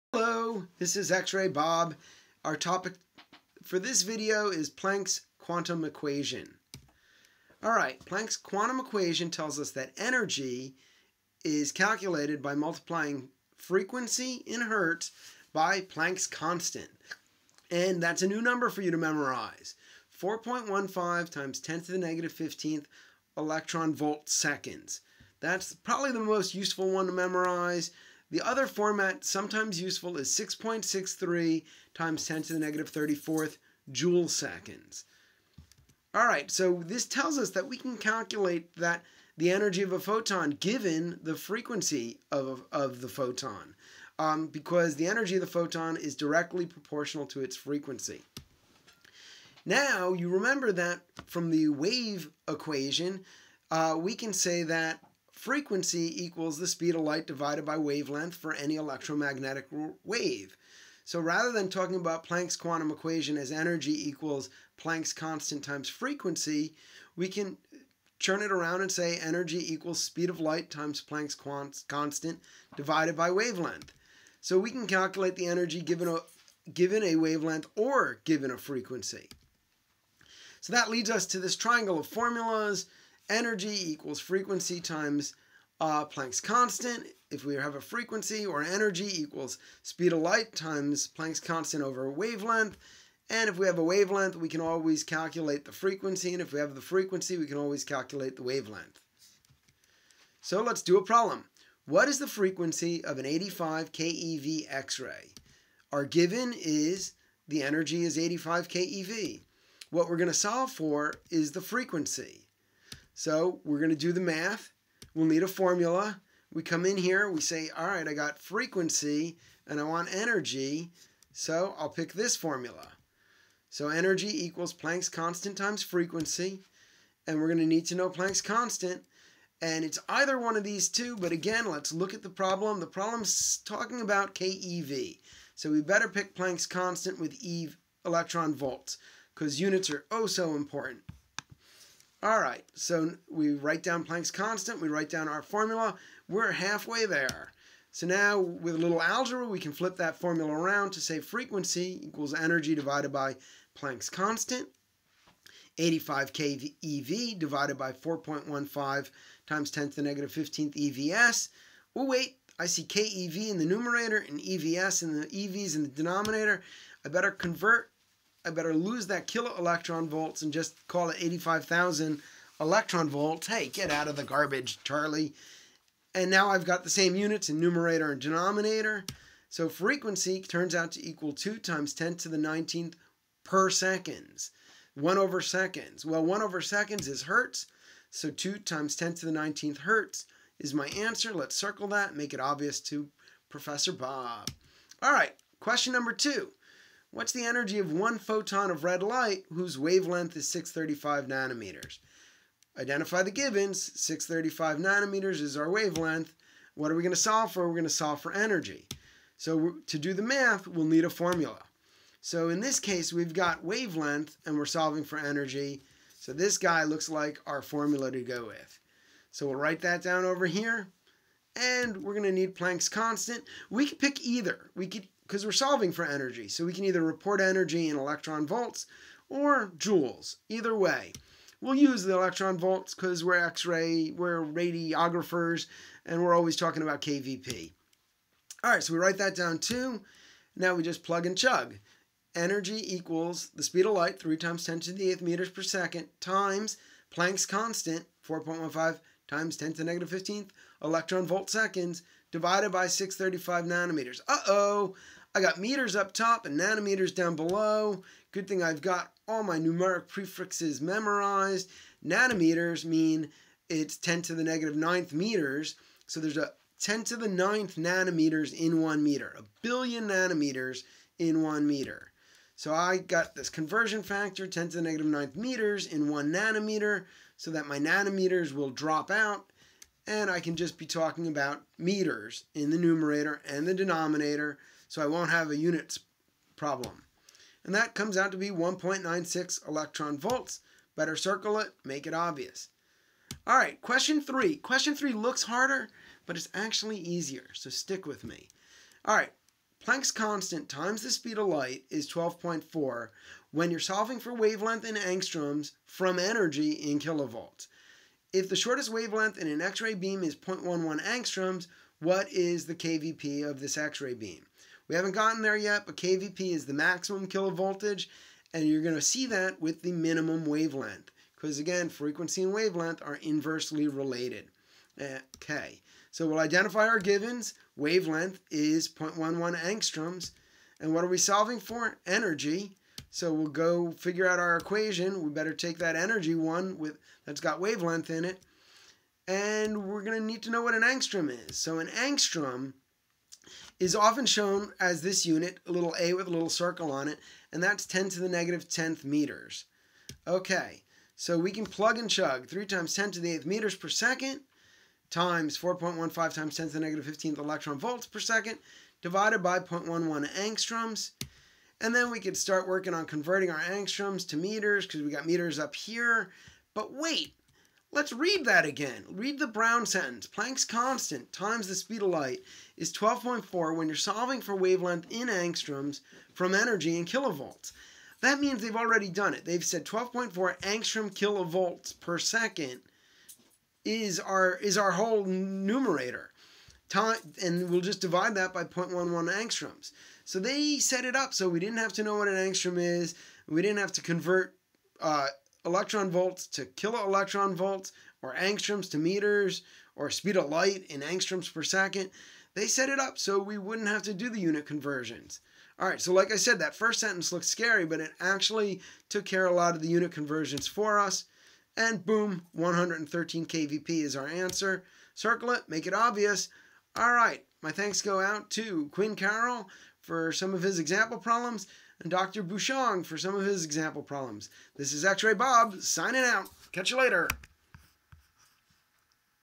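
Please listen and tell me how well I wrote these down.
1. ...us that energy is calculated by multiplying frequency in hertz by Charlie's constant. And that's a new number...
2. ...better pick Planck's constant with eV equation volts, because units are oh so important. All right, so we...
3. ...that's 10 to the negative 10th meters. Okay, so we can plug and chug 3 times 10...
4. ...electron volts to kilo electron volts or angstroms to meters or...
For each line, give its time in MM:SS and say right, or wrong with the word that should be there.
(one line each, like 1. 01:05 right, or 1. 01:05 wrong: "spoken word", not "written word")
1. 00:09 wrong: "Planck", not "Charlie"
2. 02:15 wrong: "electron", not "equation"
3. 05:47 right
4. 06:35 right.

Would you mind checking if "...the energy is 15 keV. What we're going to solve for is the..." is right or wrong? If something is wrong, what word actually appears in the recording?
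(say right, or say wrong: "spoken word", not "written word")
wrong: "85", not "15".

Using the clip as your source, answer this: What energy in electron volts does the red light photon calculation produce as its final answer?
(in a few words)
1.96 electron volts.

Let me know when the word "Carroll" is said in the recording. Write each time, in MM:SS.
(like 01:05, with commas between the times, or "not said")
06:59.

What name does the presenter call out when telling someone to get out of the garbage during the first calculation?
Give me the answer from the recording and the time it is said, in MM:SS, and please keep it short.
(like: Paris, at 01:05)
Charlie, at 02:54.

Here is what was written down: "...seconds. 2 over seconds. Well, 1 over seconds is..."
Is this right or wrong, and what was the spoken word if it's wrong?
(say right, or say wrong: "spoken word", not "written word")
wrong: "1", not "2".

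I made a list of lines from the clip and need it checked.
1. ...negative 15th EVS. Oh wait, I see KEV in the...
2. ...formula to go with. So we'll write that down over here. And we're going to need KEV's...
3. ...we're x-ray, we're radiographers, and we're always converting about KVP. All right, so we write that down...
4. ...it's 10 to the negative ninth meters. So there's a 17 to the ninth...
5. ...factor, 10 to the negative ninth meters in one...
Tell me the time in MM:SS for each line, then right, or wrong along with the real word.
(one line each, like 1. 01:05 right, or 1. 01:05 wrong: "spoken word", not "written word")
1. 02:40 right
2. 03:37 wrong: "Planck", not "KEV"
3. 03:53 wrong: "talking", not "converting"
4. 04:23 wrong: "10", not "17"
5. 04:34 right.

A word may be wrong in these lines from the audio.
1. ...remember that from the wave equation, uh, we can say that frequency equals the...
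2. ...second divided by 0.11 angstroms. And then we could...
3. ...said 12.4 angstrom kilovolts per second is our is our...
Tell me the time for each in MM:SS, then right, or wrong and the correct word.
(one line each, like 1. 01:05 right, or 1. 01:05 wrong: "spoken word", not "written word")
1. 00:50 right
2. 05:58 right
3. 06:19 right.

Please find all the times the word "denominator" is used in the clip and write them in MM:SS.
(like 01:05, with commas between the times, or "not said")
02:45, 02:58, 04:43.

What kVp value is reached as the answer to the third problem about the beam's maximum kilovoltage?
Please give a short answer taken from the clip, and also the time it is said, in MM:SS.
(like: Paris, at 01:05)
113 kVp, at 06:52.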